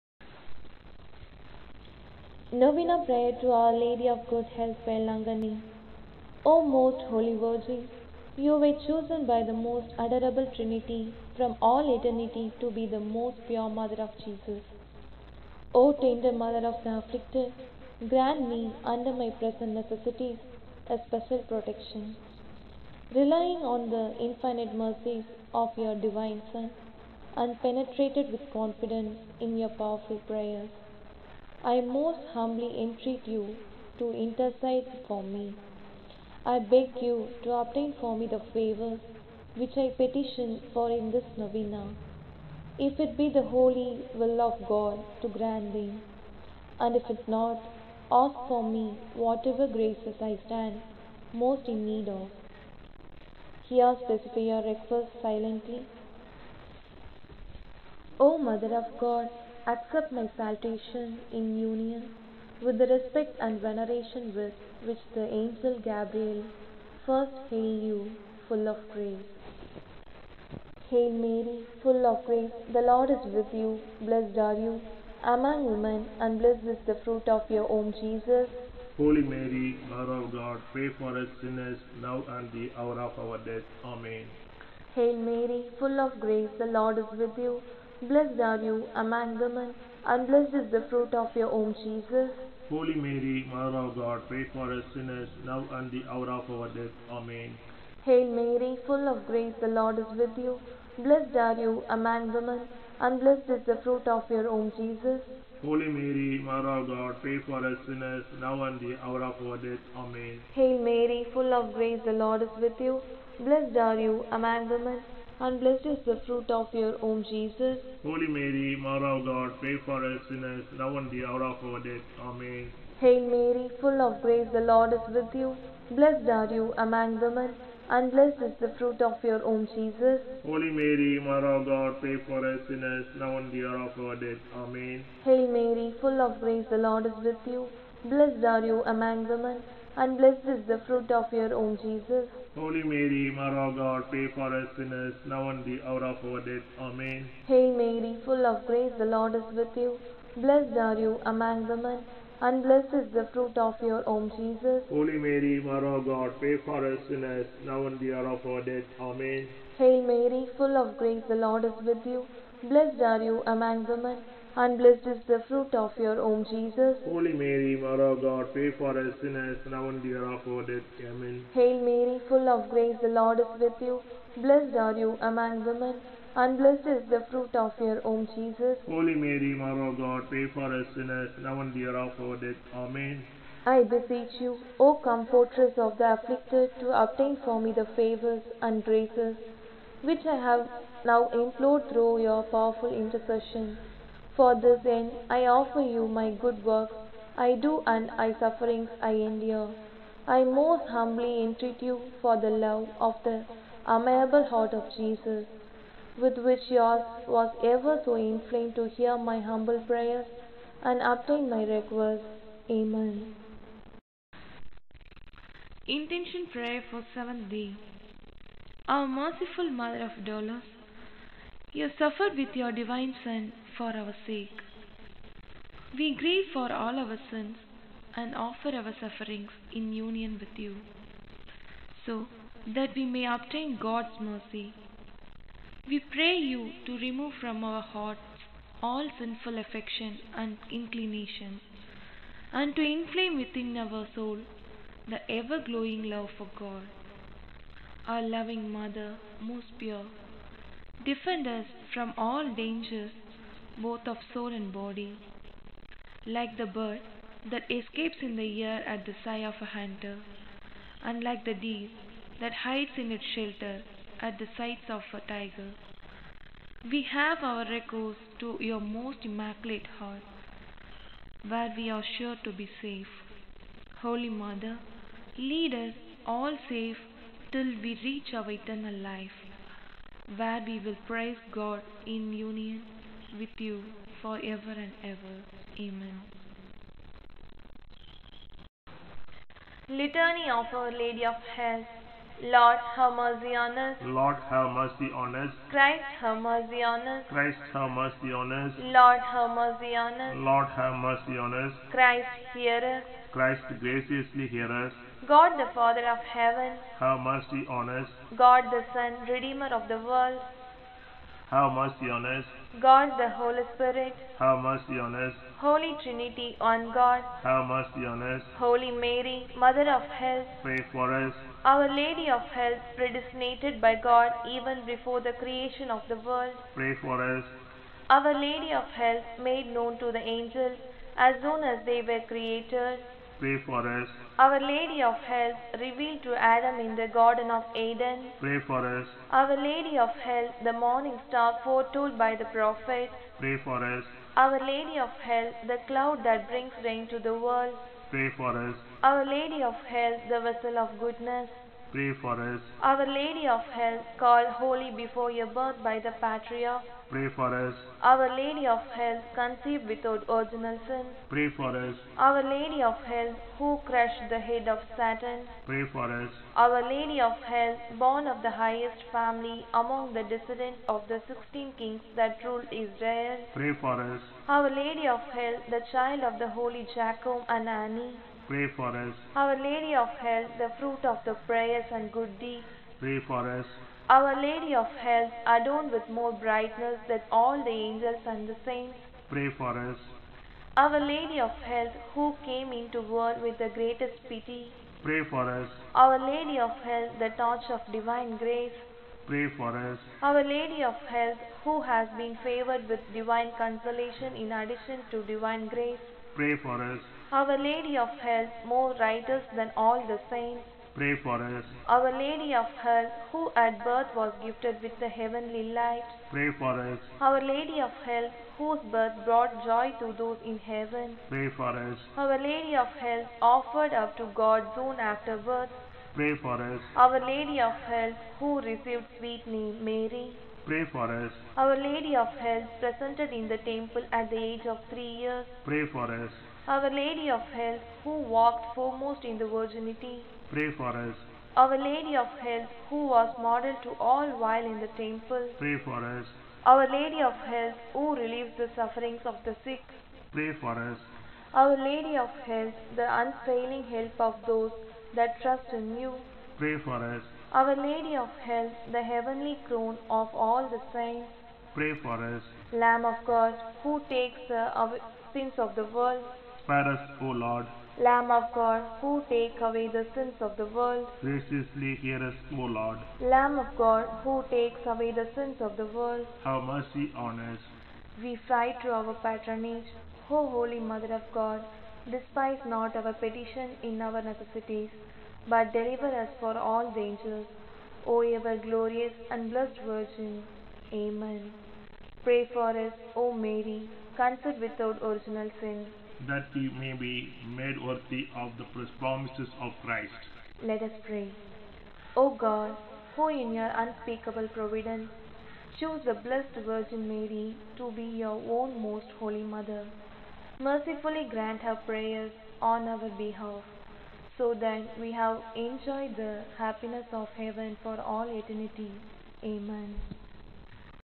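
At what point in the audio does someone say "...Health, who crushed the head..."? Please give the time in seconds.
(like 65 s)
363 s.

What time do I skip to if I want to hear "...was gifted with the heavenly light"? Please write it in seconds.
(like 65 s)
414 s.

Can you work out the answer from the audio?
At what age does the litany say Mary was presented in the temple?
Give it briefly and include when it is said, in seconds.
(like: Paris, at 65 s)
3 years, at 434 s.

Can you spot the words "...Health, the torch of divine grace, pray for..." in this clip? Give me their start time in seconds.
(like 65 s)
396 s.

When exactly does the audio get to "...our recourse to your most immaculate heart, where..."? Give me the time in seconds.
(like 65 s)
267 s.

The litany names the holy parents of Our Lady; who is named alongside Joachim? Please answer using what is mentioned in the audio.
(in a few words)
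Annie.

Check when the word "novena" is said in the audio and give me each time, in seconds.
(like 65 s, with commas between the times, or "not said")
2 s, 41 s.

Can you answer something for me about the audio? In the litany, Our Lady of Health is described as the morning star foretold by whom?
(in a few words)
the prophet.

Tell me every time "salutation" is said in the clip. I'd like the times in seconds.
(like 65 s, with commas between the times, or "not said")
60 s.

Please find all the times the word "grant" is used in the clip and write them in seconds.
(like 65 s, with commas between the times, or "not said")
18 s, 45 s, 511 s.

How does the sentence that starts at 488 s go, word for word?
O ever glorious and blessed Virgin.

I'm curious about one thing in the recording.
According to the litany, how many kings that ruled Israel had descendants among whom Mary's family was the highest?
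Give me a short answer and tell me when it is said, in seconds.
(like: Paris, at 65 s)
16, at 371 s.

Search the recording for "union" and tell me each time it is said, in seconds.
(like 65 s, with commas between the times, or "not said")
61 s, 229 s, 282 s.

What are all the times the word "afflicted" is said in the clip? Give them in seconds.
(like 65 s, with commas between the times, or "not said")
16 s, 186 s.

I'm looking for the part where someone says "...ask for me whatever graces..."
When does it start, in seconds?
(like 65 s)
48 s.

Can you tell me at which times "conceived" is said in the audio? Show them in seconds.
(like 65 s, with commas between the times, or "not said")
359 s, 494 s.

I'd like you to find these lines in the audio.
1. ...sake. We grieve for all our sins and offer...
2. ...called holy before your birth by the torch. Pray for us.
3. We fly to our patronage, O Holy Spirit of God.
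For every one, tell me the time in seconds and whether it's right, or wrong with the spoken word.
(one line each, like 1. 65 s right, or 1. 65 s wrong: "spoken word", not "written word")
1. 224 s right
2. 354 s wrong: "patriarch", not "torch"
3. 478 s wrong: "Mother", not "Spirit".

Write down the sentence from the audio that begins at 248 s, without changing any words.
Our loving Mother, most pure, defend us from all dangers both of soul and body.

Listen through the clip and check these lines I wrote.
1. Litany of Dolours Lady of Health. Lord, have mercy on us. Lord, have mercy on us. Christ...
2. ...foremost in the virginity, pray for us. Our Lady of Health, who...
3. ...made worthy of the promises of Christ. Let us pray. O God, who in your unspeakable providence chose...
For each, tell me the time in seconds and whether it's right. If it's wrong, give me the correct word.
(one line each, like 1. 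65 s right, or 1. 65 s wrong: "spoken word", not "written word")
1. 289 s wrong: "Our", not "Dolours"
2. 438 s right
3. 497 s right.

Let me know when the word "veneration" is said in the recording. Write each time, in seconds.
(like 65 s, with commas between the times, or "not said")
63 s.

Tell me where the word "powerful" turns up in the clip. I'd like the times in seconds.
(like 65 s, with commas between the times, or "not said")
29 s, 192 s.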